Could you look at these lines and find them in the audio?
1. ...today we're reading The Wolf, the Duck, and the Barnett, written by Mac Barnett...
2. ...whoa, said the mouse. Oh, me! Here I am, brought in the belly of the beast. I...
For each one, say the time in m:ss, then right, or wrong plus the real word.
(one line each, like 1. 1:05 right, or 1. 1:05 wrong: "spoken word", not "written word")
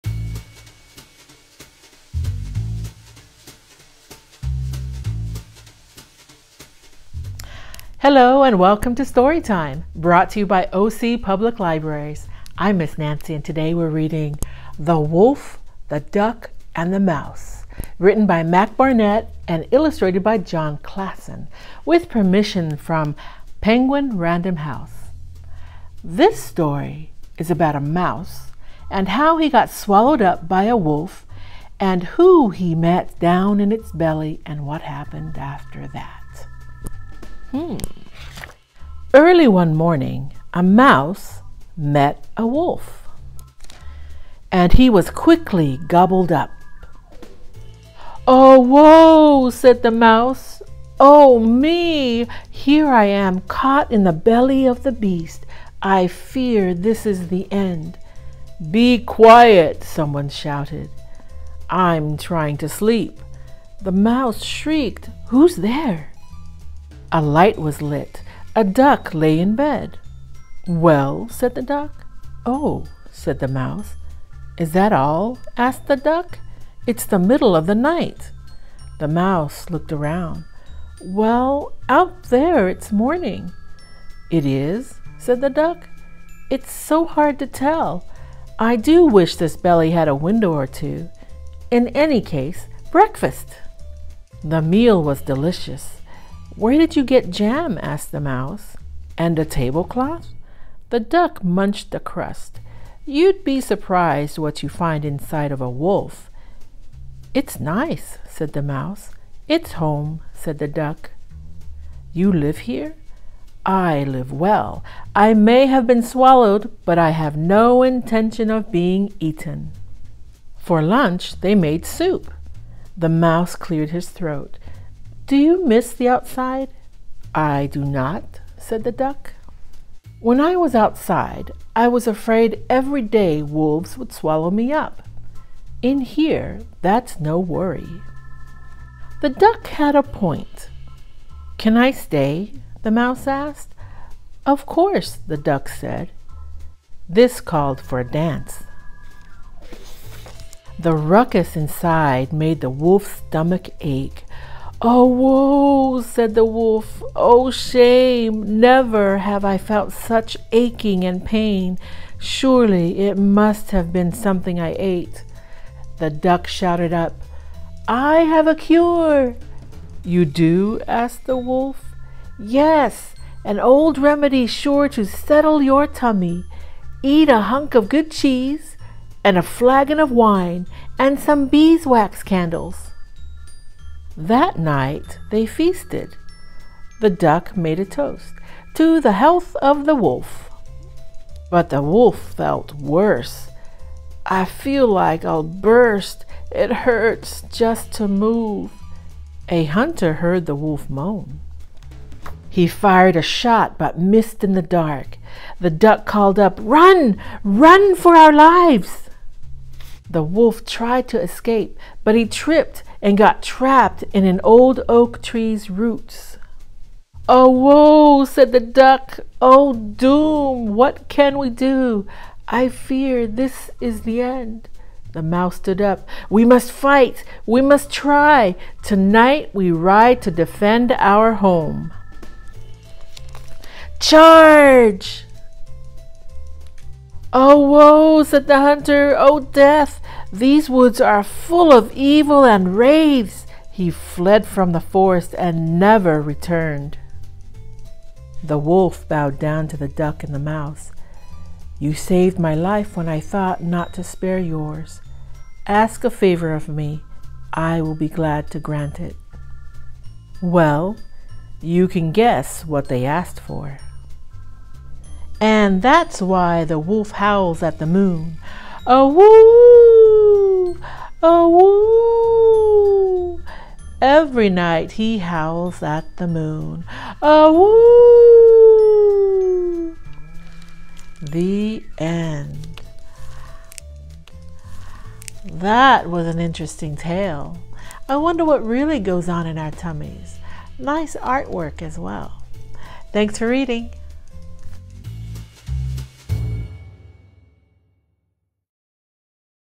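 1. 0:13 wrong: "Mouse", not "Barnett"
2. 0:48 wrong: "caught", not "brought".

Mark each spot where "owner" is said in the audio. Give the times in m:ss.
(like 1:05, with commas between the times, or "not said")
not said.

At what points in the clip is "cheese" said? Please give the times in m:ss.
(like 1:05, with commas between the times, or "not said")
2:58.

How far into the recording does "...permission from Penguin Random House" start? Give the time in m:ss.
0:22.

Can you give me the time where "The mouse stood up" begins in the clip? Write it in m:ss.
3:45.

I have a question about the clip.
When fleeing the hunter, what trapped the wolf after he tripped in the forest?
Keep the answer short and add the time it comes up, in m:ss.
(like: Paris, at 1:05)
an old oak tree's roots, at 3:34.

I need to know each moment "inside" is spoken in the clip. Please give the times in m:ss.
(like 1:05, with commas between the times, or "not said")
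1:45, 2:31.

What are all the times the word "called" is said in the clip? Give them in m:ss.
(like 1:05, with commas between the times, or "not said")
2:27, 3:26.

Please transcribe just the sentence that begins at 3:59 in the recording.
Oh, death, these woods are full of evil and wraiths.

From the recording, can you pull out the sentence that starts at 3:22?
He fired a shot but missed in the dark.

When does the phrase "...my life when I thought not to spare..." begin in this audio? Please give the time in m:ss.
4:12.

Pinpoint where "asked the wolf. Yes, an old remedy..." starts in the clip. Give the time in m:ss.
2:50.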